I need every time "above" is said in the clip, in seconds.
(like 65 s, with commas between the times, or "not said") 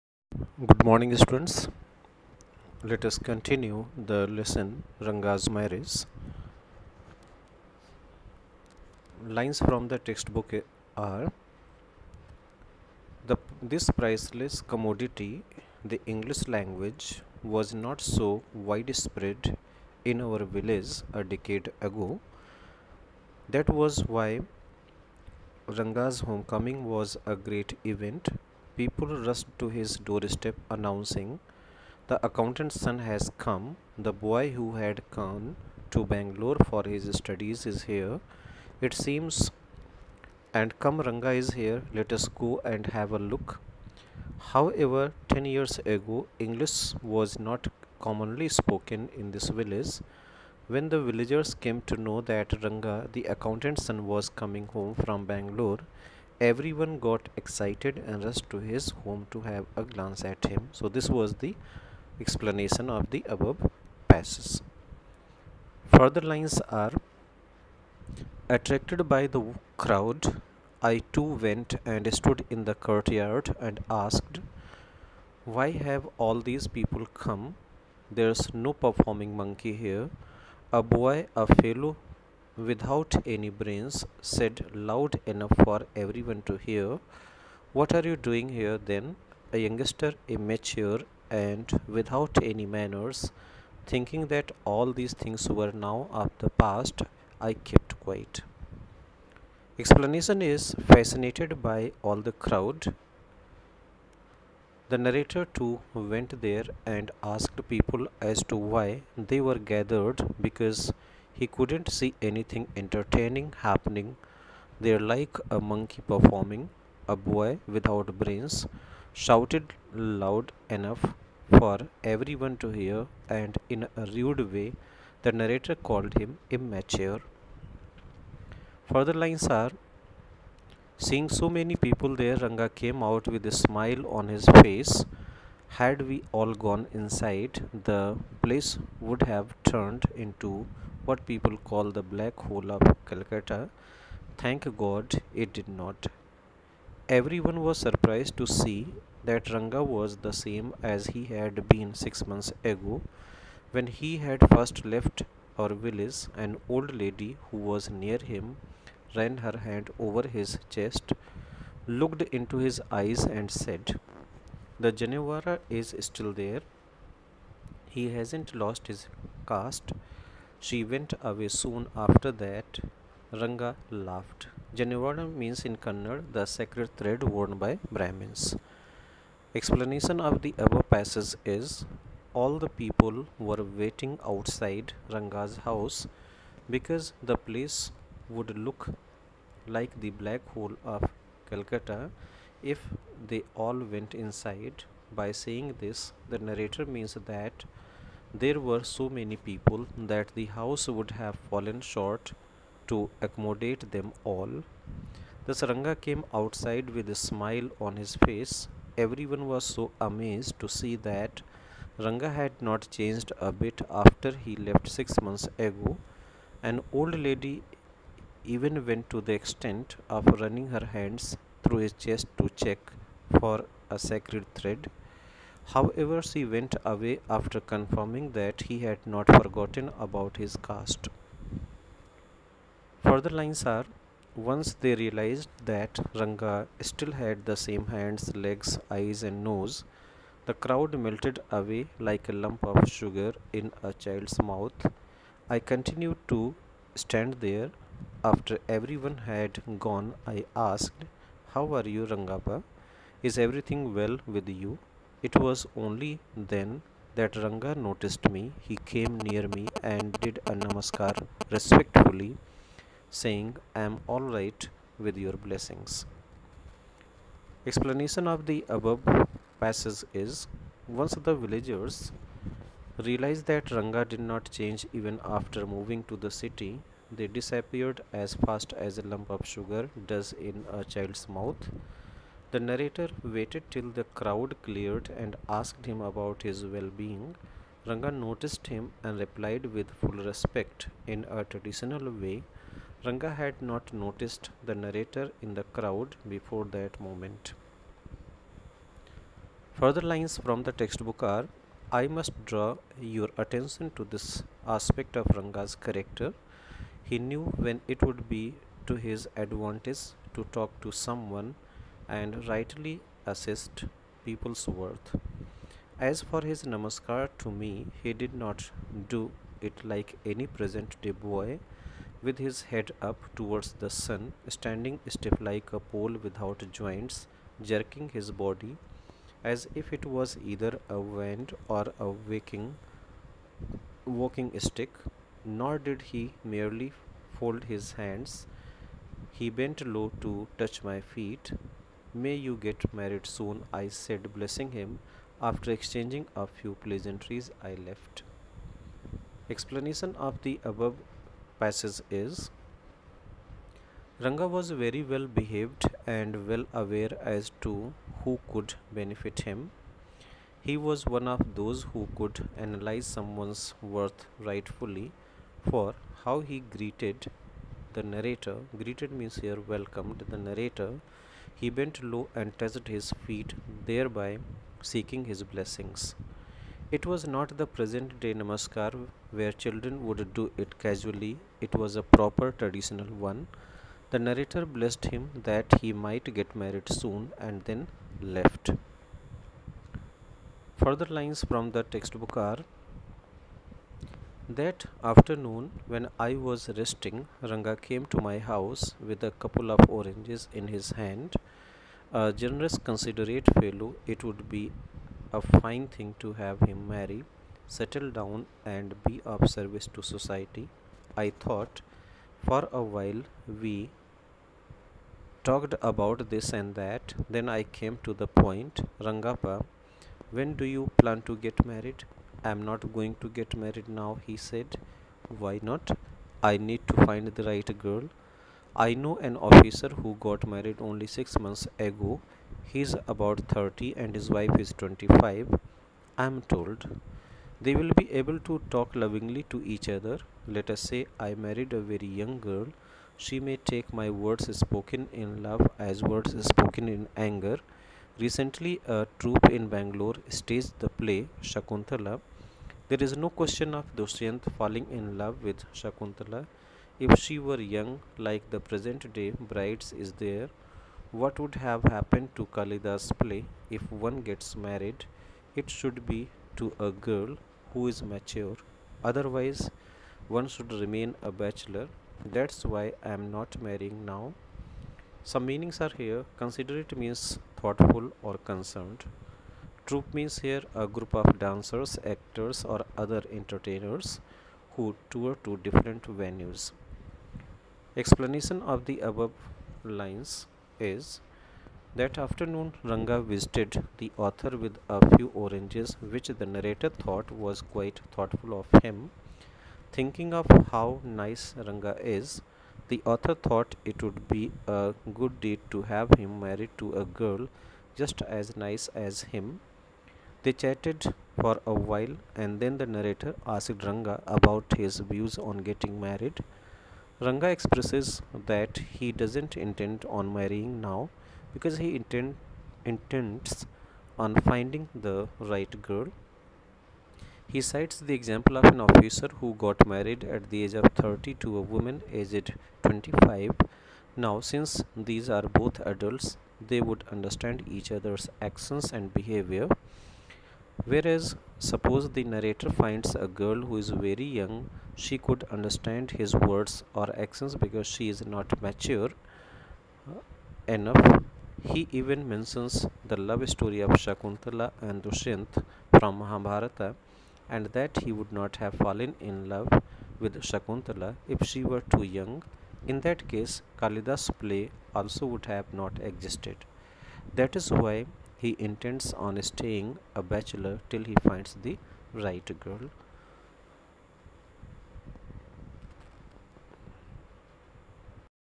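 63 s, 180 s, 268 s, 350 s, 489 s.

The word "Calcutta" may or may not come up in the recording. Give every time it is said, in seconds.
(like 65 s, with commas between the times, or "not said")
143 s, 191 s.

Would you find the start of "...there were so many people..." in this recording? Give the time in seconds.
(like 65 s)
198 s.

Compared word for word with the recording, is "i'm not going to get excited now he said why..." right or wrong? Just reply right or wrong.
wrong.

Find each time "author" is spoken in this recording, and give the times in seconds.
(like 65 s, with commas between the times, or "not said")
494 s, 503 s.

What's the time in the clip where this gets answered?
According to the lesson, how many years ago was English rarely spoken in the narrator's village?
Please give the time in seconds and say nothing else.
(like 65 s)
45 s.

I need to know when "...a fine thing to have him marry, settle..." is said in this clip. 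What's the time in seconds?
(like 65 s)
405 s.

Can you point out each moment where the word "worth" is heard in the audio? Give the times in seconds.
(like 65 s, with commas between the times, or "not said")
314 s, 363 s.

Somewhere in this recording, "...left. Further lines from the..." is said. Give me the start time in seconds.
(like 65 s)
388 s.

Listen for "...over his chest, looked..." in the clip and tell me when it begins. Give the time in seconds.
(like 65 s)
159 s.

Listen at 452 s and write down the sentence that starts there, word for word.
There is no question of Dushyant falling in love with Shakuntala.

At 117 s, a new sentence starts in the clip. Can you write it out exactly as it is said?
A boy without brains shouted loud enough for everyone to hear, and in a rude way, the narrator called him immature.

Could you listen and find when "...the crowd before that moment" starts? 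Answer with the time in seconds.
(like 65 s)
295 s.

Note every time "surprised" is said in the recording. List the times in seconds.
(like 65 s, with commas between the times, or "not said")
147 s.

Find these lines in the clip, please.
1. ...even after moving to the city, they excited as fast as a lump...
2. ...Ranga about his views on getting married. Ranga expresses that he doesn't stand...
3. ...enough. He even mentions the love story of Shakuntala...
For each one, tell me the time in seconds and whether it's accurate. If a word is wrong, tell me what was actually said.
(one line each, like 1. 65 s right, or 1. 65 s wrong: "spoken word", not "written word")
1. 274 s wrong: "disappeared", not "excited"
2. 513 s wrong: "intend", not "stand"
3. 550 s right.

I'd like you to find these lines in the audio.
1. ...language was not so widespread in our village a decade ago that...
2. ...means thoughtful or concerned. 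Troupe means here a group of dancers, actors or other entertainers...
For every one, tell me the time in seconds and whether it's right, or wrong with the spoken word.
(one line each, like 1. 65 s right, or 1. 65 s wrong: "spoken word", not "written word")
1. 16 s right
2. 476 s right.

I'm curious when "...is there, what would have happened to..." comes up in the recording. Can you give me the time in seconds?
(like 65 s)
459 s.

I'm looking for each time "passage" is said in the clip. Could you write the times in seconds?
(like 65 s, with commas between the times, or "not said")
64 s, 180 s, 269 s, 351 s.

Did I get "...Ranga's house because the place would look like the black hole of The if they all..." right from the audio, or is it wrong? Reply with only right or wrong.
wrong.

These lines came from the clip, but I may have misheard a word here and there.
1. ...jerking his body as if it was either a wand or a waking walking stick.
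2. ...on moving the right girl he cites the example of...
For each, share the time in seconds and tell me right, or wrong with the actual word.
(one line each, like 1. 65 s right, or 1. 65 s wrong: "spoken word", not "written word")
1. 327 s right
2. 524 s wrong: "finding", not "moving".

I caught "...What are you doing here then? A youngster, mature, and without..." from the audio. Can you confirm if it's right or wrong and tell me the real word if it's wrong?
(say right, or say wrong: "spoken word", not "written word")
wrong: "immature", not "mature".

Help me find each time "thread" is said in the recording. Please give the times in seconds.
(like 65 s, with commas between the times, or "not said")
176 s, 224 s.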